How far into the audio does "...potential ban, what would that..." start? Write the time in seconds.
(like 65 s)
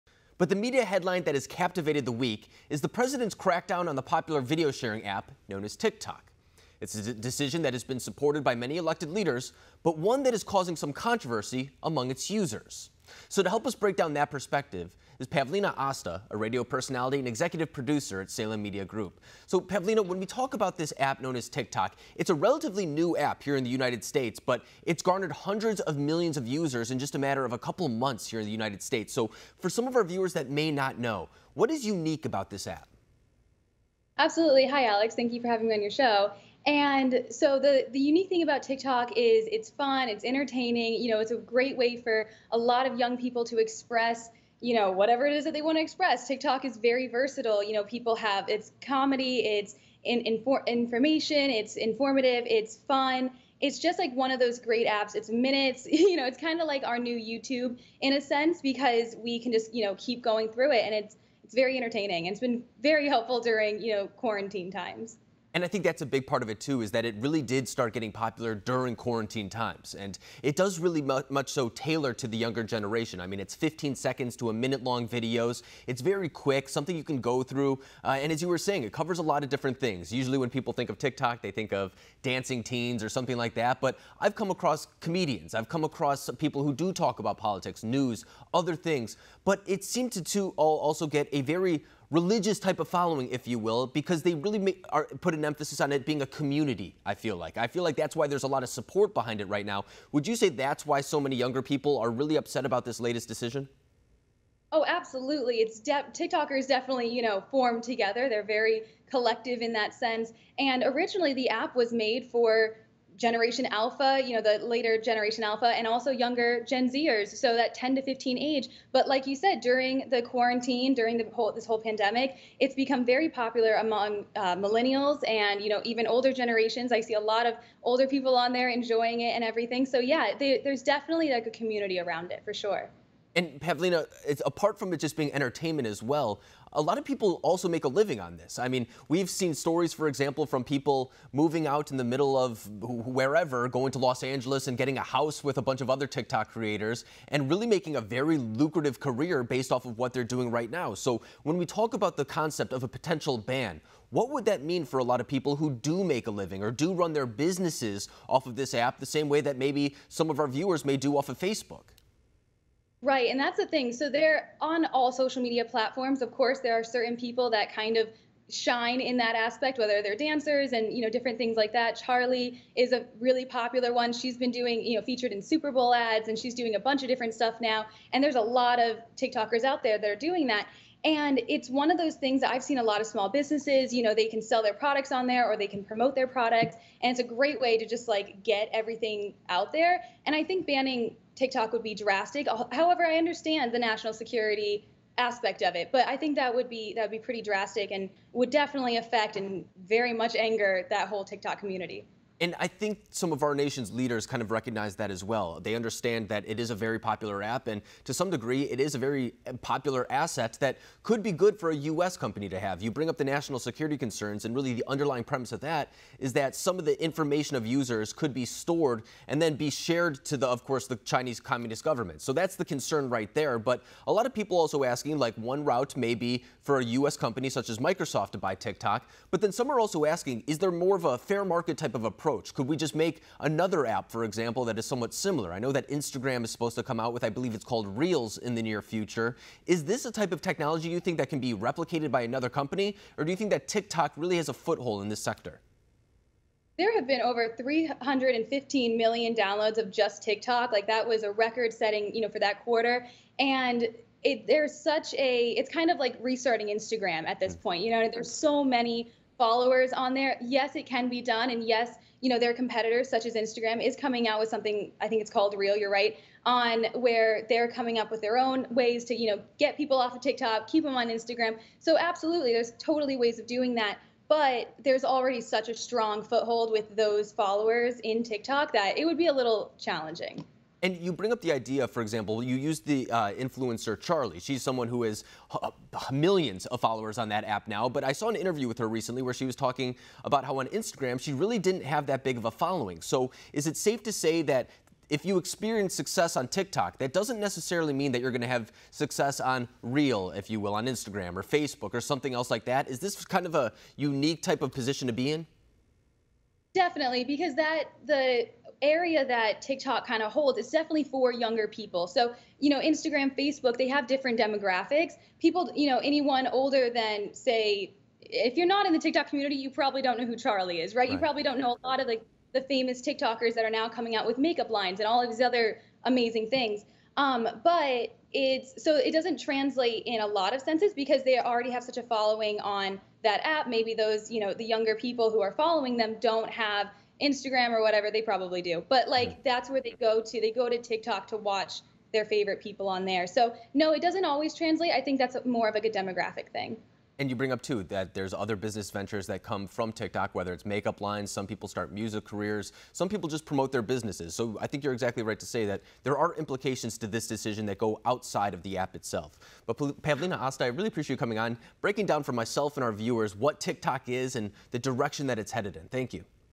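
152 s.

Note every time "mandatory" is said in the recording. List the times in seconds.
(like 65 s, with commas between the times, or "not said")
not said.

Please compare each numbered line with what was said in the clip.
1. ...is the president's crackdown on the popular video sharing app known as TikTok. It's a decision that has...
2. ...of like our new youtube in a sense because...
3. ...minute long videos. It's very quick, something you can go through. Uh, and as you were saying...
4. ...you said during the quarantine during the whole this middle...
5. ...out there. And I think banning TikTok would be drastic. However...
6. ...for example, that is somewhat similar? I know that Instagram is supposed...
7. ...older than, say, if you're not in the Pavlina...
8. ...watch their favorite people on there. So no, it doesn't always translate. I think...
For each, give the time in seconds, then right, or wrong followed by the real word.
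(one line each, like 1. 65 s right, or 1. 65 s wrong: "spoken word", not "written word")
1. 2 s right
2. 56 s right
3. 74 s right
4. 119 s wrong: "whole", not "middle"
5. 189 s right
6. 234 s right
7. 316 s wrong: "TikTok", not "Pavlina"
8. 341 s right.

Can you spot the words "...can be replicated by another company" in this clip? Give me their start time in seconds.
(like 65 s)
241 s.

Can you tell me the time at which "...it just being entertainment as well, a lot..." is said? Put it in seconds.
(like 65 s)
134 s.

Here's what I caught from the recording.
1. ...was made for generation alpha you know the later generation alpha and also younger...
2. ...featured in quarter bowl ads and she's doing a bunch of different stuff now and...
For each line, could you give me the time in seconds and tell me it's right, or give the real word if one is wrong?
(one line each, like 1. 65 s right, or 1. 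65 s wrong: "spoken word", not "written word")
1. 111 s right
2. 175 s wrong: "super", not "quarter".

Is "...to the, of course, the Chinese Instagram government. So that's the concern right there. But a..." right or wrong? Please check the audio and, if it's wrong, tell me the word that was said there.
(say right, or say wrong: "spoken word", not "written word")
wrong: "Communist", not "Instagram".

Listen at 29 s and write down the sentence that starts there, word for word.
So, for some of our viewers that may not know, what is unique about this app?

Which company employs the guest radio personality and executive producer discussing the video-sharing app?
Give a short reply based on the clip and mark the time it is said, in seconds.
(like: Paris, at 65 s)
Salem Media Group, at 18 s.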